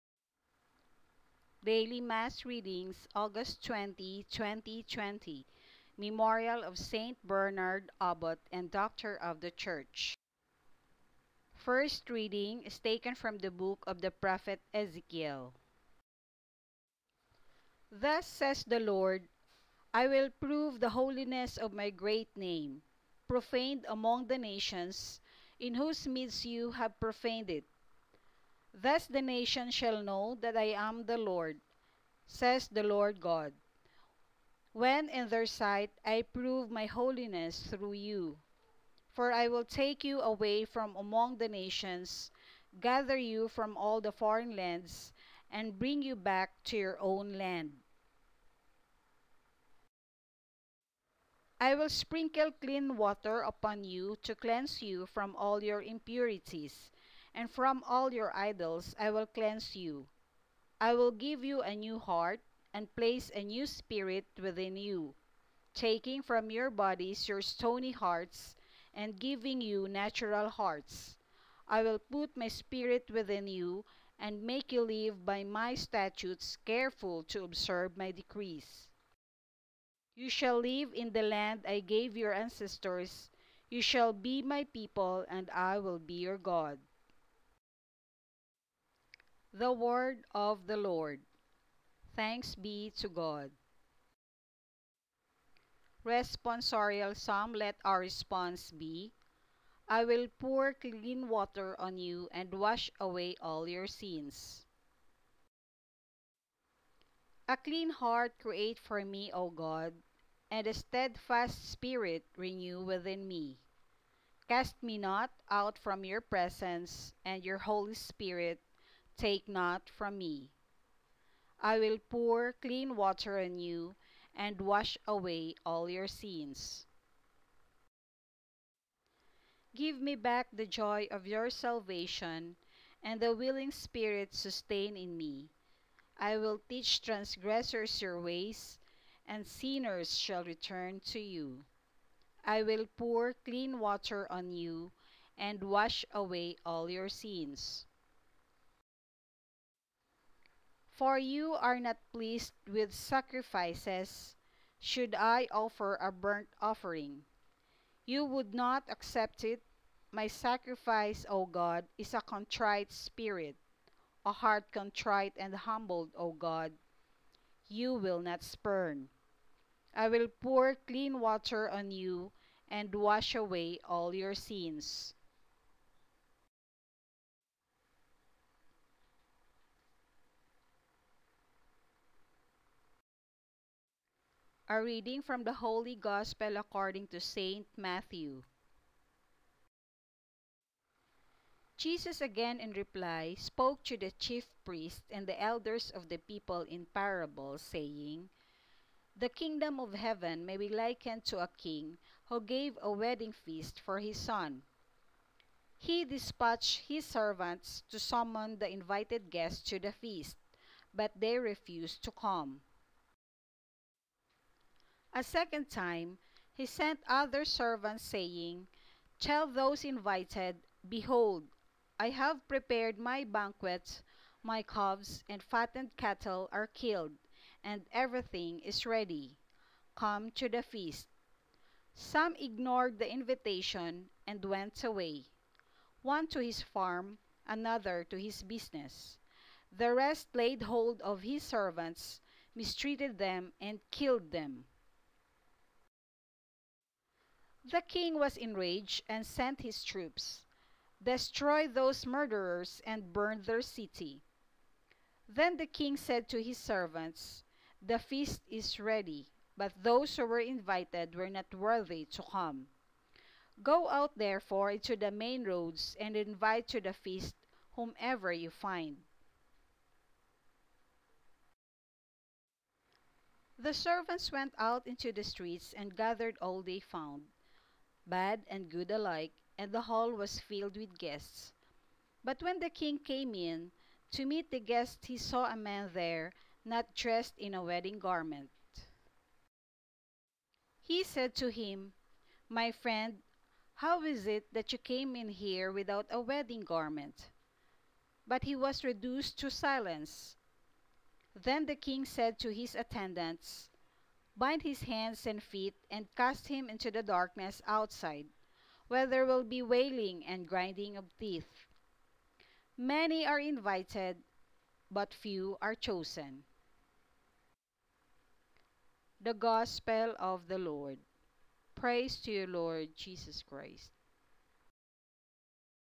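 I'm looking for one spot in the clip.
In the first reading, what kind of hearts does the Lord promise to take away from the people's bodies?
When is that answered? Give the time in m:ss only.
1:07.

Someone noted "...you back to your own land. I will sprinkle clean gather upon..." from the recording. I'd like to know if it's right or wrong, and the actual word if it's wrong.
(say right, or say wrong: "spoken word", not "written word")
wrong: "water", not "gather".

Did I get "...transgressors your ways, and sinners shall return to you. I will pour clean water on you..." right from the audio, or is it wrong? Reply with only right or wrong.
right.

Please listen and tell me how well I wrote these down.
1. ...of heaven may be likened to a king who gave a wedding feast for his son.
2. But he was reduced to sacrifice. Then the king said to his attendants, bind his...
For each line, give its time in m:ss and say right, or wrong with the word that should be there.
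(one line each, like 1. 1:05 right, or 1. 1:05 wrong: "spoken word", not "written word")
1. 3:19 right
2. 4:58 wrong: "silence", not "sacrifice".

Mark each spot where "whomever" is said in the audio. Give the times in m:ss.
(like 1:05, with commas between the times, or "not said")
4:27.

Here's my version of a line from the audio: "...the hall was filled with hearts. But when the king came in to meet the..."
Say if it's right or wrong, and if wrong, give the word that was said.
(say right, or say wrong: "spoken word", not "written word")
wrong: "guests", not "hearts".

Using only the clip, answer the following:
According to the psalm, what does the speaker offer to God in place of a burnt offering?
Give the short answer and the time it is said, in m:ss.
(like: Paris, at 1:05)
a contrite spirit, at 2:42.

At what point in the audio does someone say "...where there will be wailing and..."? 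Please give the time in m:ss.
5:08.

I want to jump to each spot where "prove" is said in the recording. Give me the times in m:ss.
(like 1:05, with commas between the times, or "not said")
0:20, 0:36.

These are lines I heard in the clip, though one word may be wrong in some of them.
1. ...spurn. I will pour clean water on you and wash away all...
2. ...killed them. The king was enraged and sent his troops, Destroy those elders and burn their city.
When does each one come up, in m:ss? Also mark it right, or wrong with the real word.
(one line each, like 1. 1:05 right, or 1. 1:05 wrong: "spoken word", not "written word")
1. 2:48 right
2. 4:03 wrong: "murderers", not "elders".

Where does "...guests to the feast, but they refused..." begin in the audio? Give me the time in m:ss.
3:29.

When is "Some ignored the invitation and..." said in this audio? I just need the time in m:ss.
3:51.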